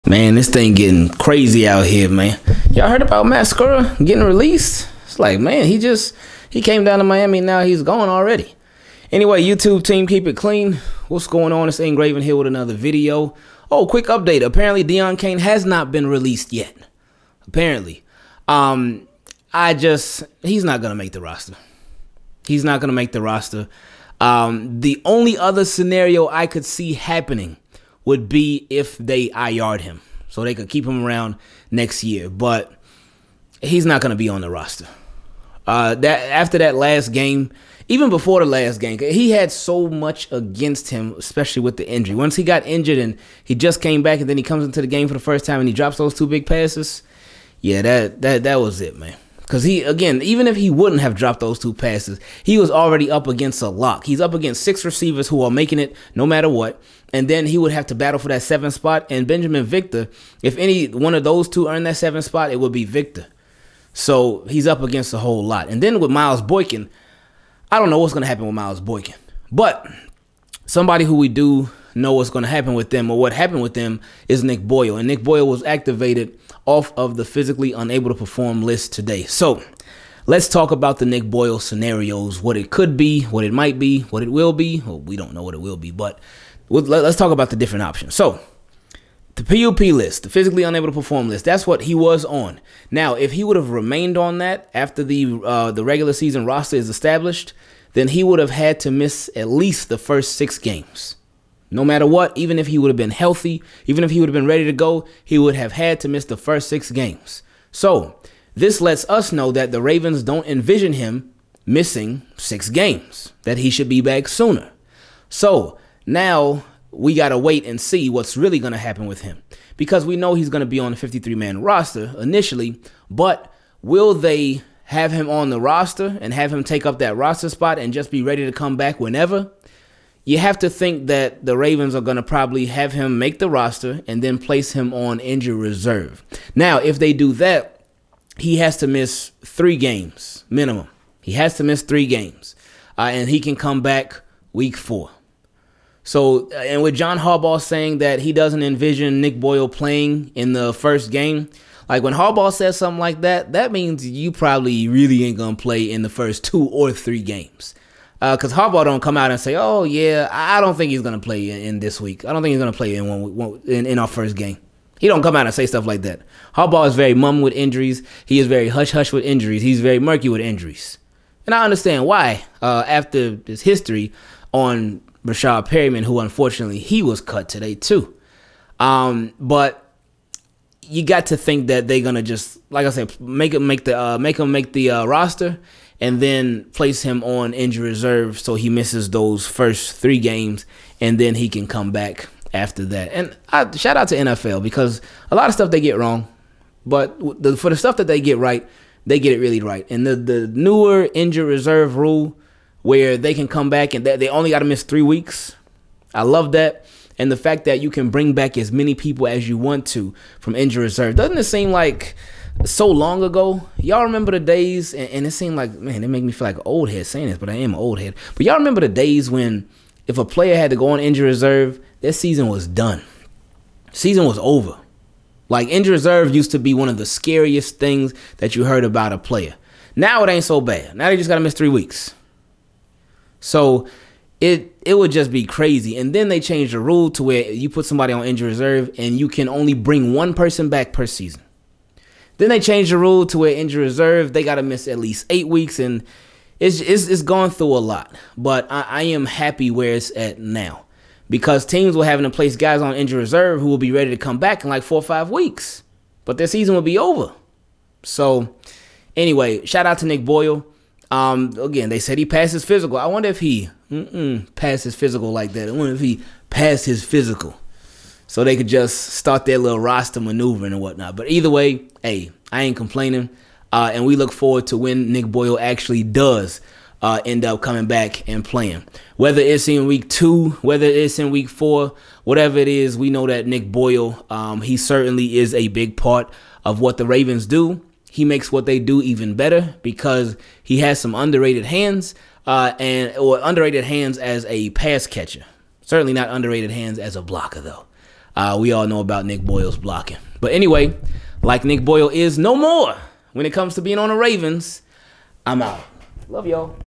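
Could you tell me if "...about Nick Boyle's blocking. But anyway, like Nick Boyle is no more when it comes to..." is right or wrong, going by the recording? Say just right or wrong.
right.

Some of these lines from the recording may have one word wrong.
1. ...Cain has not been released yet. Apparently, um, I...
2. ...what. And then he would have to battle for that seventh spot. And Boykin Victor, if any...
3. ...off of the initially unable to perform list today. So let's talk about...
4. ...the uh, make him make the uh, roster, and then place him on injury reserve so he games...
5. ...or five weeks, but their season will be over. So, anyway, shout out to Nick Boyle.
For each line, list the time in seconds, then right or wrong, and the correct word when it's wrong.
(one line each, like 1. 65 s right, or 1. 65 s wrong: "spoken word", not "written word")
1. 15 s right
2. 56 s wrong: "Binjimen", not "Boykin"
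3. 76 s wrong: "physically", not "initially"
4. 183 s wrong: "misses", not "games"
5. 254 s right.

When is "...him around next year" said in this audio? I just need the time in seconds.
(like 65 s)
30 s.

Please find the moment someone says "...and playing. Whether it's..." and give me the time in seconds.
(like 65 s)
278 s.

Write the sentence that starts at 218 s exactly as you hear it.
But y'all remember the days when if a player had to go on injury reserve, their season was done.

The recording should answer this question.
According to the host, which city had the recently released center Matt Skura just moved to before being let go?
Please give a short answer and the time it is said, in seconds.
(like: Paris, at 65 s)
Miami, at 7 s.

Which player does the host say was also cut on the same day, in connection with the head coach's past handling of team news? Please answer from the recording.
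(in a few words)
Bashar Perryman.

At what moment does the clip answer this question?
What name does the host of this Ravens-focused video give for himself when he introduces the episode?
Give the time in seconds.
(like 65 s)
11 s.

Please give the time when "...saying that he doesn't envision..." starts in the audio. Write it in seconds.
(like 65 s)
147 s.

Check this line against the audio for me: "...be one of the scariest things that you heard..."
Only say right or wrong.
right.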